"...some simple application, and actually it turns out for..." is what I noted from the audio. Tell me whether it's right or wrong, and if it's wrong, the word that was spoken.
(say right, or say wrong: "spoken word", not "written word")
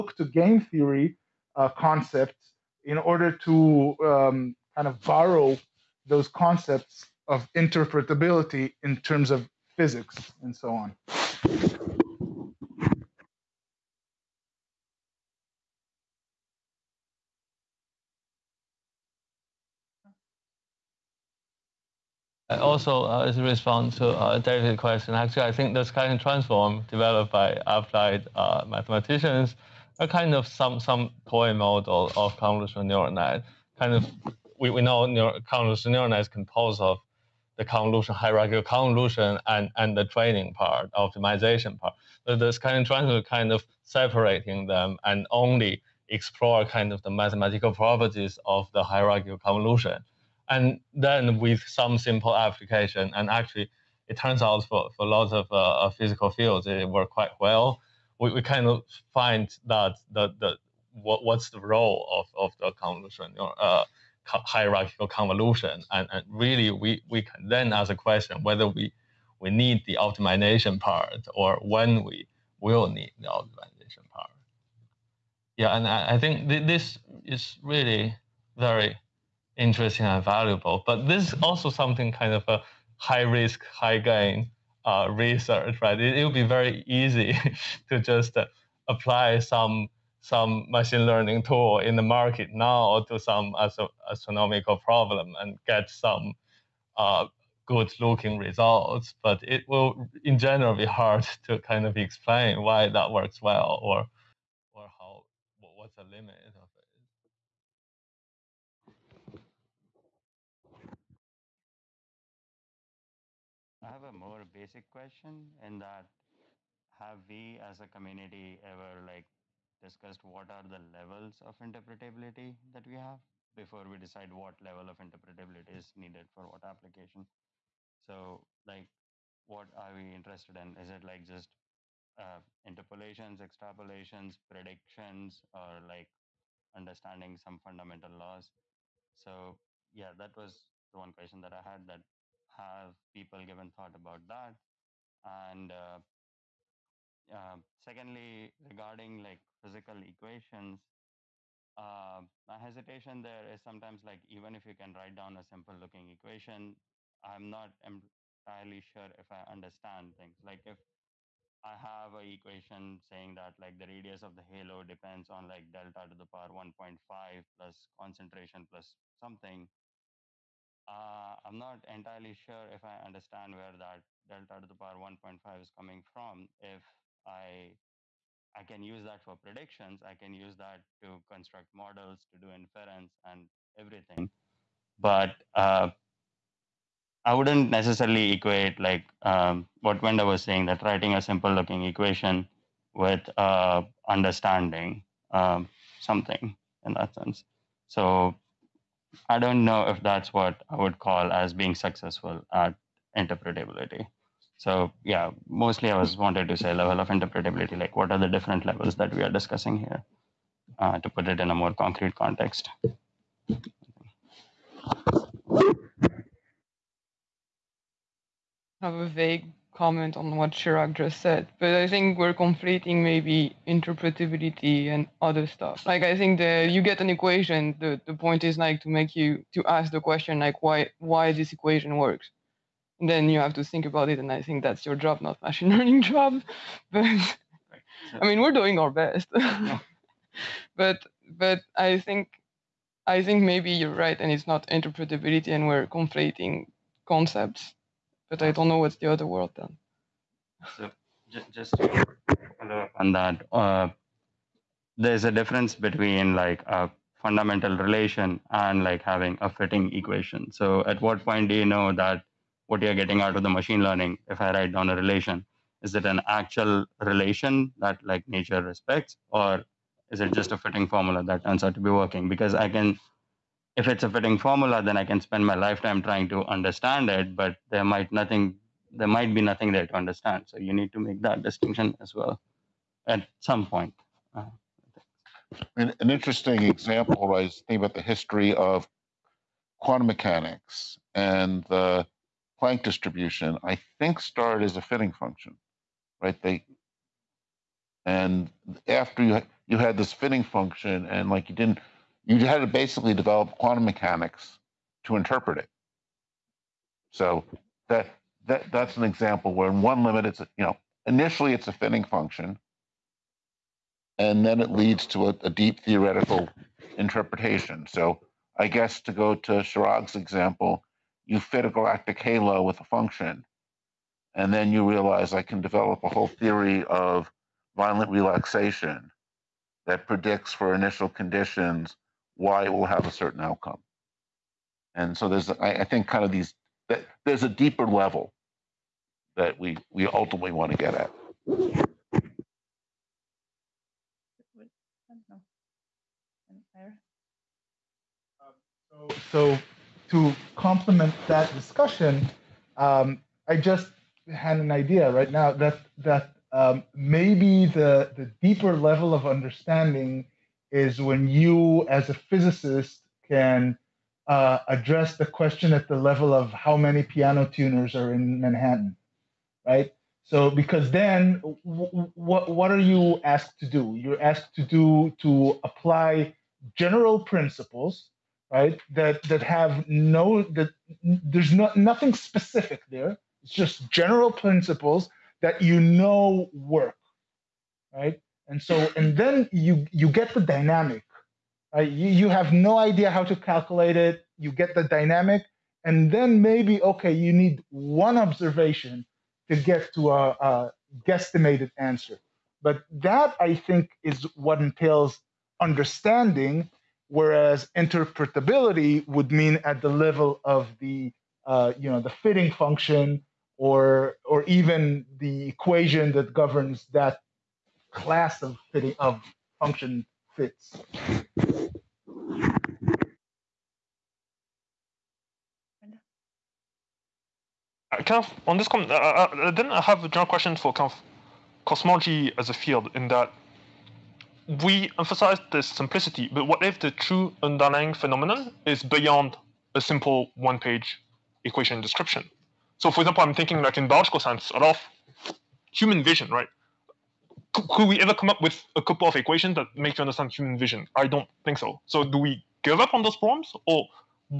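right.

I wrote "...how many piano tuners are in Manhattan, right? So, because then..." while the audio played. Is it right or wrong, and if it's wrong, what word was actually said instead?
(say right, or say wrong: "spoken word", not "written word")
right.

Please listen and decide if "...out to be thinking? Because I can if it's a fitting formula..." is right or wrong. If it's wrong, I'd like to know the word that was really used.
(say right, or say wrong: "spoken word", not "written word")
wrong: "working", not "thinking".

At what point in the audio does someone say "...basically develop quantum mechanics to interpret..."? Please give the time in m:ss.
5:02.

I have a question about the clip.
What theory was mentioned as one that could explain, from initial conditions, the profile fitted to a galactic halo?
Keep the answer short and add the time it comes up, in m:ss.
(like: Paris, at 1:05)
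violent relaxation, at 5:27.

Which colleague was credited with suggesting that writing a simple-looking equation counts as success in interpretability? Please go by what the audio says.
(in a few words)
Wenda.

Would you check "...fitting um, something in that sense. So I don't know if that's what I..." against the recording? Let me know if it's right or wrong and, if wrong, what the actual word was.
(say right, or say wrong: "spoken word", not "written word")
wrong: "understanding", not "fitting".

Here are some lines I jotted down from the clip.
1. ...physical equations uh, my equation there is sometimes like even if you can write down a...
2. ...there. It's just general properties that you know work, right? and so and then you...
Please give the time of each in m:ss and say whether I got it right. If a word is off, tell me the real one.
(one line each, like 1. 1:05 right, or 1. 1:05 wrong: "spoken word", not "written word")
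1. 2:29 wrong: "hesitation", not "equation"
2. 6:22 wrong: "principles", not "properties".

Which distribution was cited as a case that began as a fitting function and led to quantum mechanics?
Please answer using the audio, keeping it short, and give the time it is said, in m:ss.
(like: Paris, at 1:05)
Planck distribution, at 4:52.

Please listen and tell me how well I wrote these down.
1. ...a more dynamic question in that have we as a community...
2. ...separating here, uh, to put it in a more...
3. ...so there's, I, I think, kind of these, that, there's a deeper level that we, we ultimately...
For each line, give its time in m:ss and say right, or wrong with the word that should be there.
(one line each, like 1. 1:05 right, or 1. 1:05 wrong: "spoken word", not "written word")
1. 1:54 wrong: "basic", not "dynamic"
2. 3:29 wrong: "discussing", not "separating"
3. 5:35 right.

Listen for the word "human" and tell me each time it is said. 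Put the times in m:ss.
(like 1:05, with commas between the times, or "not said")
7:25, 7:30.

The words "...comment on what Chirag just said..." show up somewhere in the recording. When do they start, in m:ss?
3:39.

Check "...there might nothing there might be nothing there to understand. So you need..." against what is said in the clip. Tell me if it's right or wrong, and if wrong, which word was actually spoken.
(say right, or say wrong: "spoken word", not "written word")
right.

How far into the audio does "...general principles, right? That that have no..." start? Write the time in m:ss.
6:16.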